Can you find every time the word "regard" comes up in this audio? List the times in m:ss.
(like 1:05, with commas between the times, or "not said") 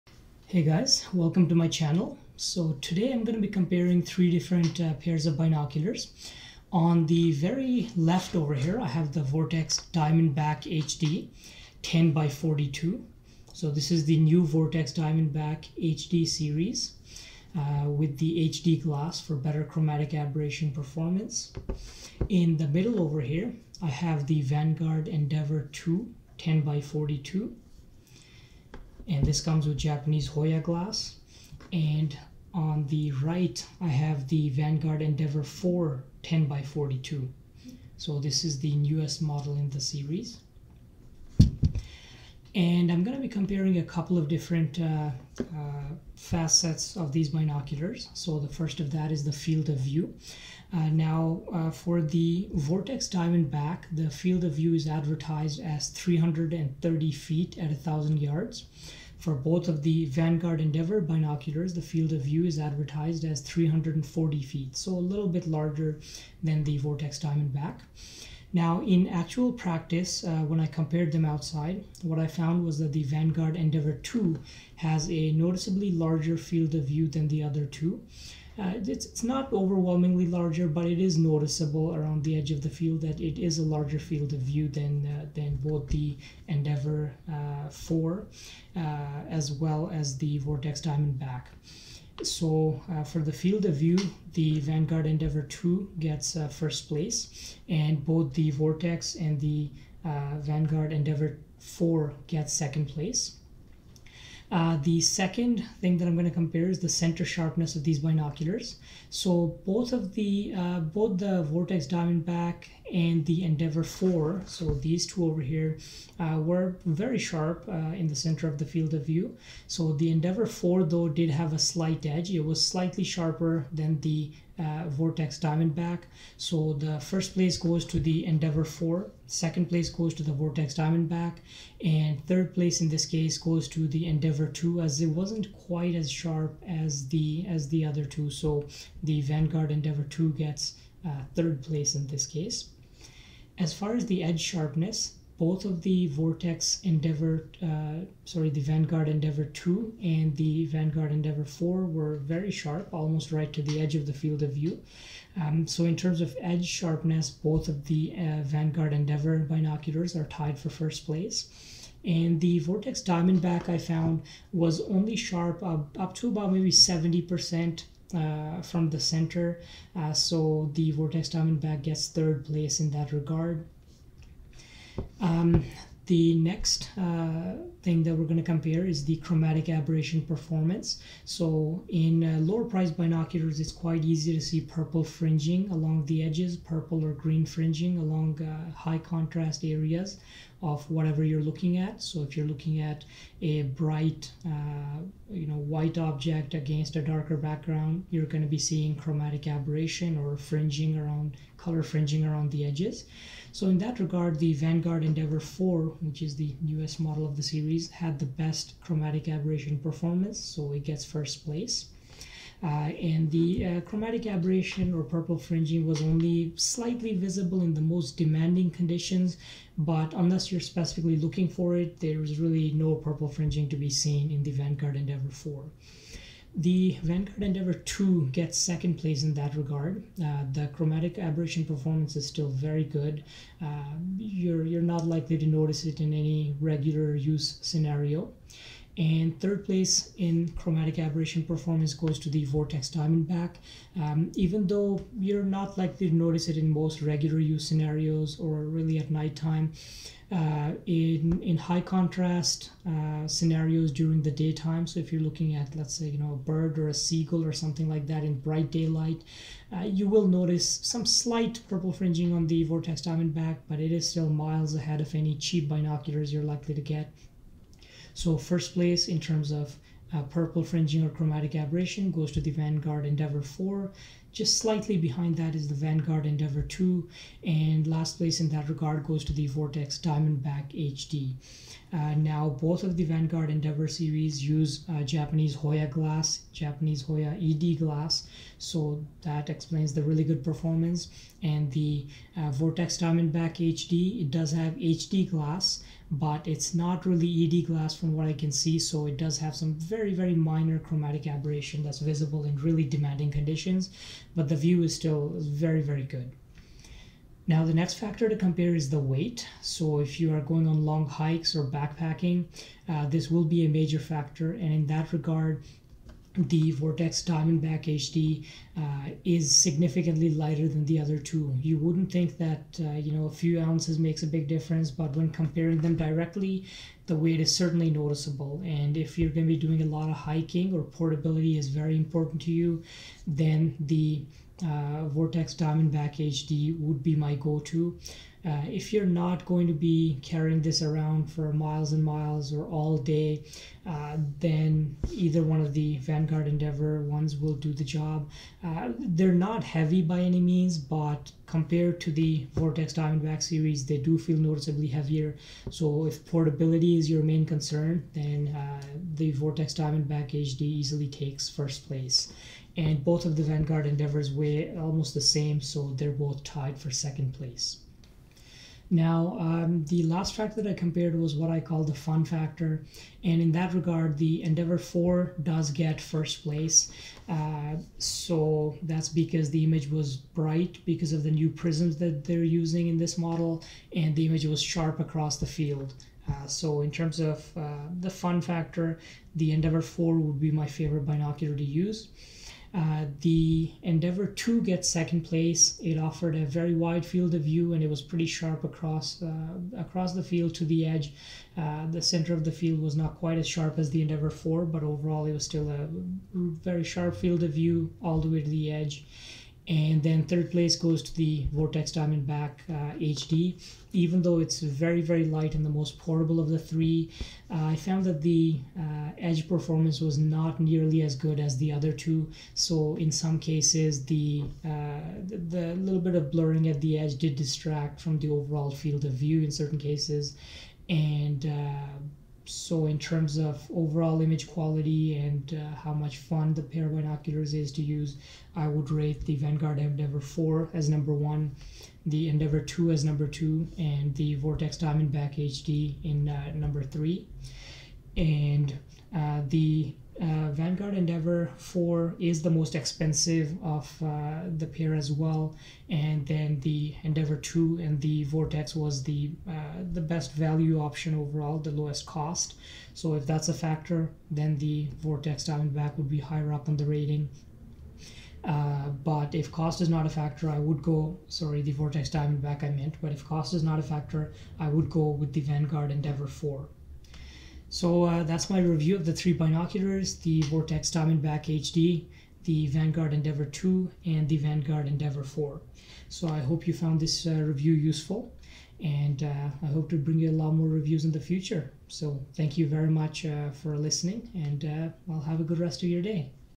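2:53, 3:23, 3:49, 4:38, 5:15, 6:13.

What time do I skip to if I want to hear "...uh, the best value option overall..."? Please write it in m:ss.
7:39.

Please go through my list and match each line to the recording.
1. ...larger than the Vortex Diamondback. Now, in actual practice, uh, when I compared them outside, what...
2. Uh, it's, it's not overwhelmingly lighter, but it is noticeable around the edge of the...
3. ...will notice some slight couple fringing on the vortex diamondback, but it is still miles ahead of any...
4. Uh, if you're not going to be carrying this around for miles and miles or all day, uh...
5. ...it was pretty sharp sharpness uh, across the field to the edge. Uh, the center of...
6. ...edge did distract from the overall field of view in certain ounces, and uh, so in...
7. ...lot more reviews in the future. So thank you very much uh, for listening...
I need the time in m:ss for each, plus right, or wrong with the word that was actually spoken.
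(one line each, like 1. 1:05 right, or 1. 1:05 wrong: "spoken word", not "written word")
1. 1:05 right
2. 1:18 wrong: "larger", not "lighter"
3. 4:20 wrong: "purple", not "couple"
4. 5:38 right
5. 6:37 wrong: "across", not "sharpness"
6. 7:06 wrong: "cases", not "ounces"
7. 8:10 right.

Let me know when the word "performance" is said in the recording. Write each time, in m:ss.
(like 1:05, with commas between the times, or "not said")
0:20, 3:00, 3:29, 3:51, 4:01, 4:50, 6:59.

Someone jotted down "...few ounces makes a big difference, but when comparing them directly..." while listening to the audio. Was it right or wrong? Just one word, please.
right.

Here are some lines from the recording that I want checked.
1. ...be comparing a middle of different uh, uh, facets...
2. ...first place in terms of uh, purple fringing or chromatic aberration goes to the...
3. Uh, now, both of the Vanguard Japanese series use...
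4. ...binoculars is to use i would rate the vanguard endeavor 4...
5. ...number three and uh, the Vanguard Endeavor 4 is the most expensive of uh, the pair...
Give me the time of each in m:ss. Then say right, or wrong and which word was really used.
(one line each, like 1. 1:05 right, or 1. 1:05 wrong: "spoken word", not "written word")
1. 0:43 wrong: "couple", not "middle"
2. 4:28 right
3. 4:41 wrong: "Endeavor", not "Japanese"
4. 7:16 right
5. 7:26 right.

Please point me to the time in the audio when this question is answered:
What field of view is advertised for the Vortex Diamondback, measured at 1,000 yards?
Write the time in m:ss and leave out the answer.
0:55.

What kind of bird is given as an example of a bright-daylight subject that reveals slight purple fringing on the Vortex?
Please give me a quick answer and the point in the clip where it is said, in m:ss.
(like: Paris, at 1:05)
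seagull, at 4:16.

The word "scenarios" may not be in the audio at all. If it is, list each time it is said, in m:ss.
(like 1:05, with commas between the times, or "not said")
3:57, 4:07, 4:13.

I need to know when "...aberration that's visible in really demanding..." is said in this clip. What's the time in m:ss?
5:01.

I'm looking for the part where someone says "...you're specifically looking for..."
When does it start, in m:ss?
3:40.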